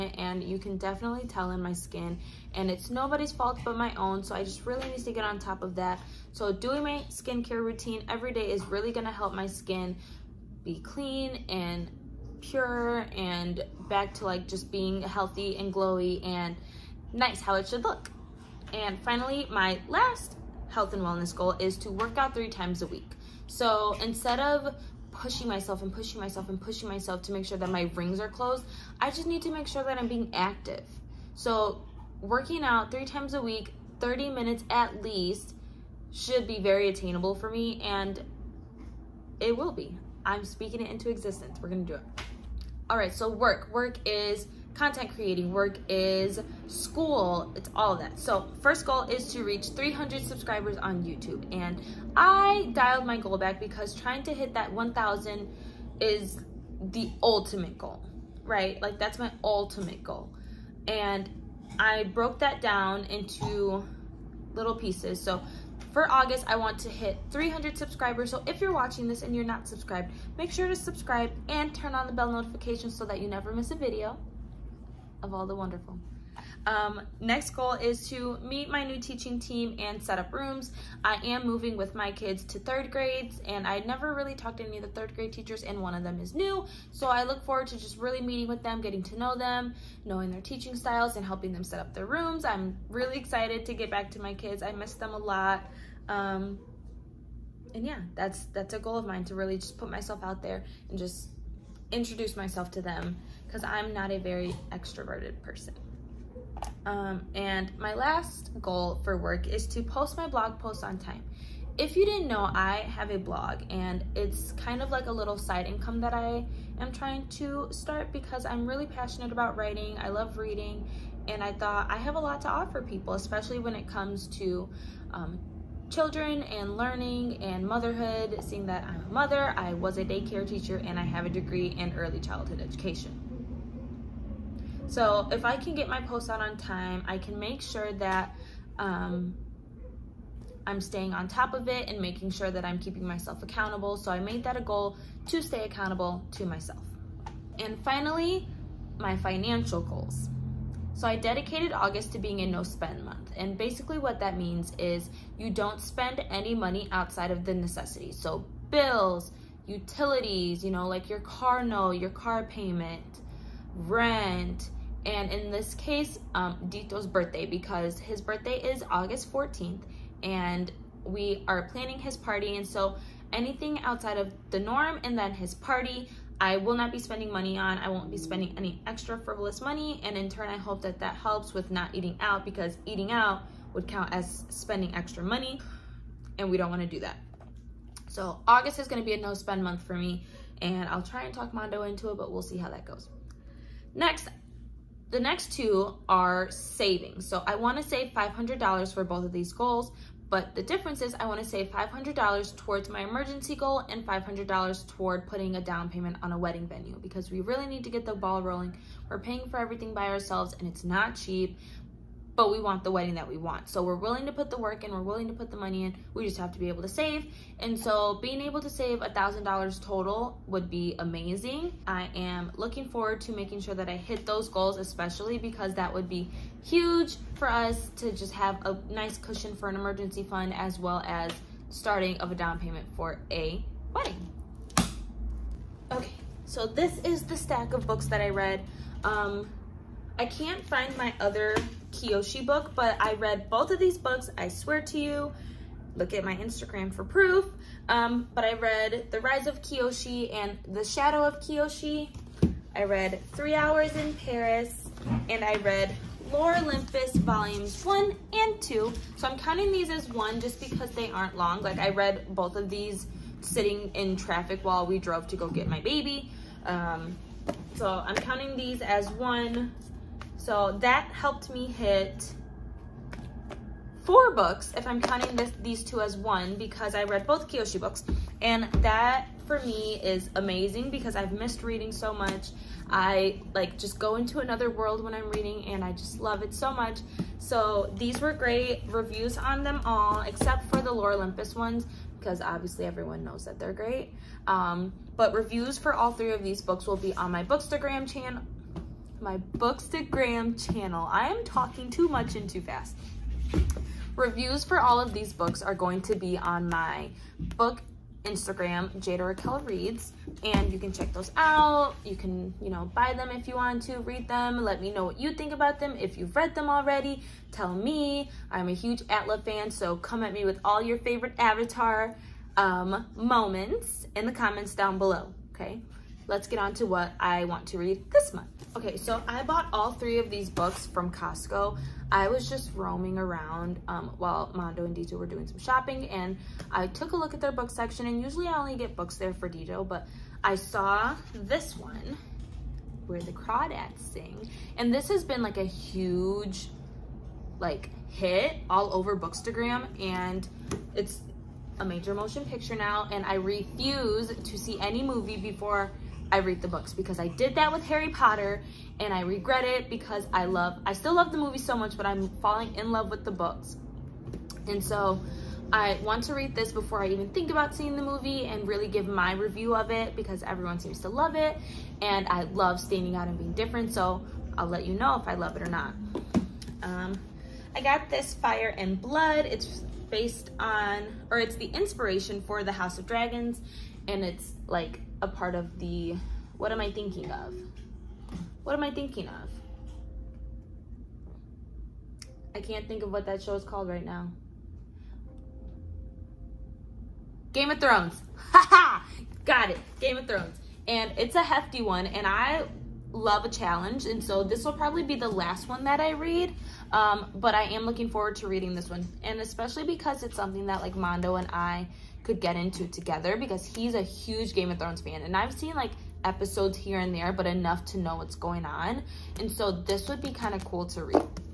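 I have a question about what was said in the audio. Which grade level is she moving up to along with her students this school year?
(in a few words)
third grade.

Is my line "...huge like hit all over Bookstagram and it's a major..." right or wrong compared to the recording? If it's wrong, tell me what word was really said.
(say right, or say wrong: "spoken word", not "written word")
right.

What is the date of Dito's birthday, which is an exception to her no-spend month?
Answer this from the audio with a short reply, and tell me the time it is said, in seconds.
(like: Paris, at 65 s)
August 14th, at 168 s.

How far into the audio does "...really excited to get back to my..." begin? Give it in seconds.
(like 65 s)
92 s.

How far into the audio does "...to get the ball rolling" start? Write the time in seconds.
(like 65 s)
207 s.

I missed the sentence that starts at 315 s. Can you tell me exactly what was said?
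If you've read them already, tell me.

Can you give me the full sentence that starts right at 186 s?
And we don't want to do that.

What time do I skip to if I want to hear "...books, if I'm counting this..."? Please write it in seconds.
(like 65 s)
274 s.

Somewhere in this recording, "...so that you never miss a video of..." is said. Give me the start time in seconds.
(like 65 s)
72 s.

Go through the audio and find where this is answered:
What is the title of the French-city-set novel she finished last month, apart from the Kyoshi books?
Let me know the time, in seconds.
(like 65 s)
253 s.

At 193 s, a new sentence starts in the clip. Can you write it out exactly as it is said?
Next, the next two are savings.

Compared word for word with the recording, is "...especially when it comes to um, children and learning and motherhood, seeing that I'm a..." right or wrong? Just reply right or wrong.
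right.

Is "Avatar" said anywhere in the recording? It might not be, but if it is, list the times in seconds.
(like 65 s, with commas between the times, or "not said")
321 s.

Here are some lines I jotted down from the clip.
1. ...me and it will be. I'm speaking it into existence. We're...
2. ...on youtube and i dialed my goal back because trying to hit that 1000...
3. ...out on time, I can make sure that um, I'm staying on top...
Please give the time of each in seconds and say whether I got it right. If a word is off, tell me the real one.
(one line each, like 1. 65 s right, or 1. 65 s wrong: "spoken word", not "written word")
1. 37 s right
2. 50 s right
3. 136 s right.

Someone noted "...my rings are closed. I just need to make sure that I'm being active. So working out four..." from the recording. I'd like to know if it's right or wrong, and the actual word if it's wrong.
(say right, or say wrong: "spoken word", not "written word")
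wrong: "three", not "four".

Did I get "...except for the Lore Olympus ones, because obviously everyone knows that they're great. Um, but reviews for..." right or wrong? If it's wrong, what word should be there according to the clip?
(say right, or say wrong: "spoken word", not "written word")
right.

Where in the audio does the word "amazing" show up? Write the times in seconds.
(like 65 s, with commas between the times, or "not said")
221 s, 280 s.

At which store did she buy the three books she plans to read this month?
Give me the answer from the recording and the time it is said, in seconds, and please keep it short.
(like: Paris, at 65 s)
Costco, at 331 s.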